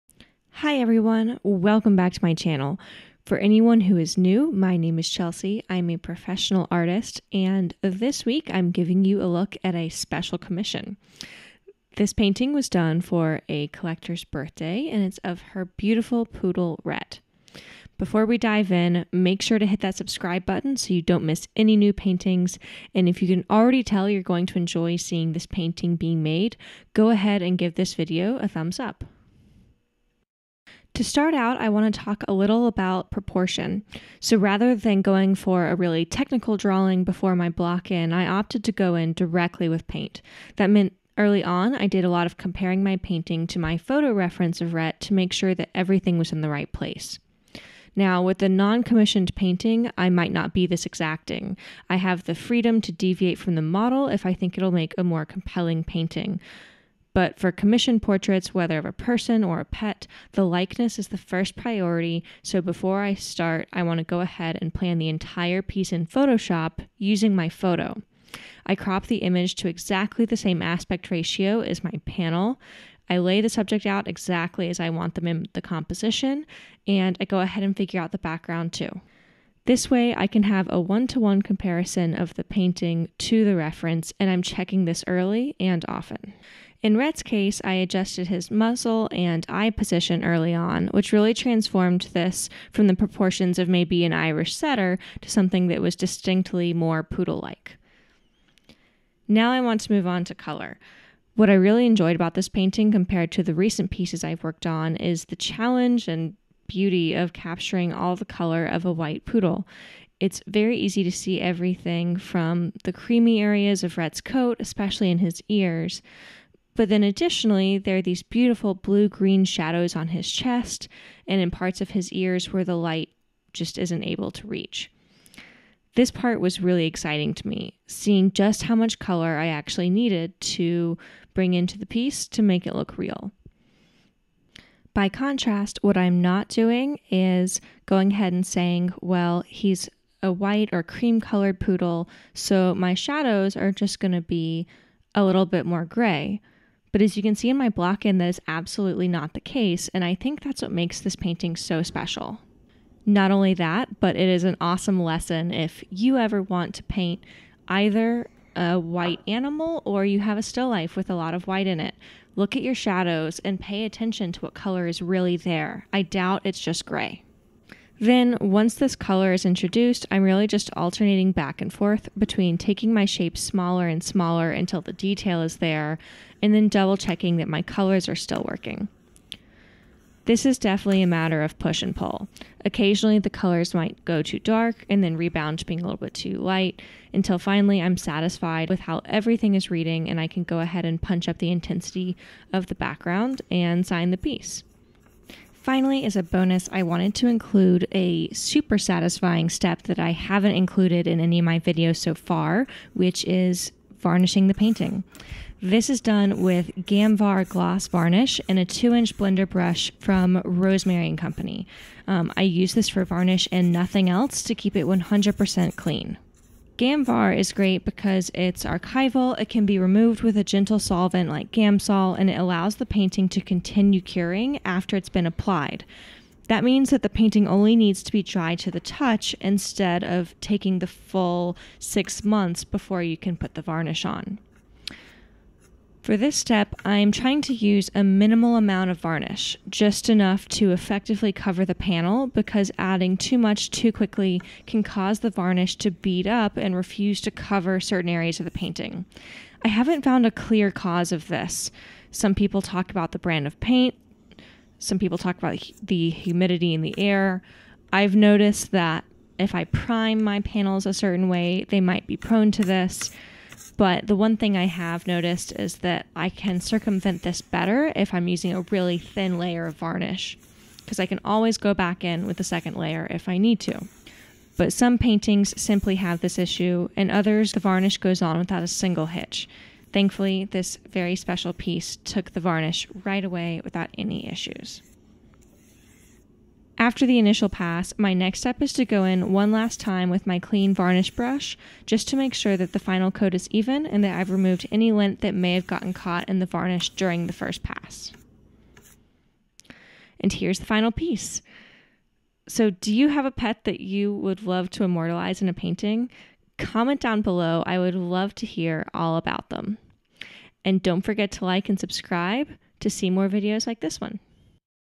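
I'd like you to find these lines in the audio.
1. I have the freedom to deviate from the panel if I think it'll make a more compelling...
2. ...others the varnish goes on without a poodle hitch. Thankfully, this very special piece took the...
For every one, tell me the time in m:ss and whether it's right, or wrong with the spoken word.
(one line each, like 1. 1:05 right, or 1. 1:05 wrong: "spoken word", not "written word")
1. 0:51 wrong: "model", not "panel"
2. 4:37 wrong: "single", not "poodle".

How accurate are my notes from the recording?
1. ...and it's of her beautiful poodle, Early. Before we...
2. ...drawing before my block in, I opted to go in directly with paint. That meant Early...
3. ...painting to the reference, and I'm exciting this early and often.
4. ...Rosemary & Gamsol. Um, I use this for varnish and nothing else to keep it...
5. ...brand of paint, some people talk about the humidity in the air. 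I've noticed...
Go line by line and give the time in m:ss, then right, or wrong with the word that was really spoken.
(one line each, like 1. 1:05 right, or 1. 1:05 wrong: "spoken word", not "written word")
1. 0:14 wrong: "Rhett", not "Early"
2. 0:36 right
3. 1:22 wrong: "checking", not "exciting"
4. 3:30 wrong: "Company", not "Gamsol"
5. 4:13 right.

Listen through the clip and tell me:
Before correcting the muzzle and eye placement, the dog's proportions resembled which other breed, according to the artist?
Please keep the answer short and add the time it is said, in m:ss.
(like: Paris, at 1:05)
Irish setter, at 1:34.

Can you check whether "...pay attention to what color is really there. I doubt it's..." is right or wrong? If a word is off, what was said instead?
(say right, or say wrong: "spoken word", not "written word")
right.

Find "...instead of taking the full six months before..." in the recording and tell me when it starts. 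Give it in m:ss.
3:49.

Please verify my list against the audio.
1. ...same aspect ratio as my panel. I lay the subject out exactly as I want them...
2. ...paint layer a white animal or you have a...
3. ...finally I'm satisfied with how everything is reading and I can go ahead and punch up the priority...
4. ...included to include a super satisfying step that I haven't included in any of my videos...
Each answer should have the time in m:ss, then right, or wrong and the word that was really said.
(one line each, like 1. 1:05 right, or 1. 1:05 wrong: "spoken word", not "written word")
1. 1:10 right
2. 2:36 wrong: "either", not "layer"
3. 3:07 wrong: "intensity", not "priority"
4. 3:16 wrong: "wanted", not "included".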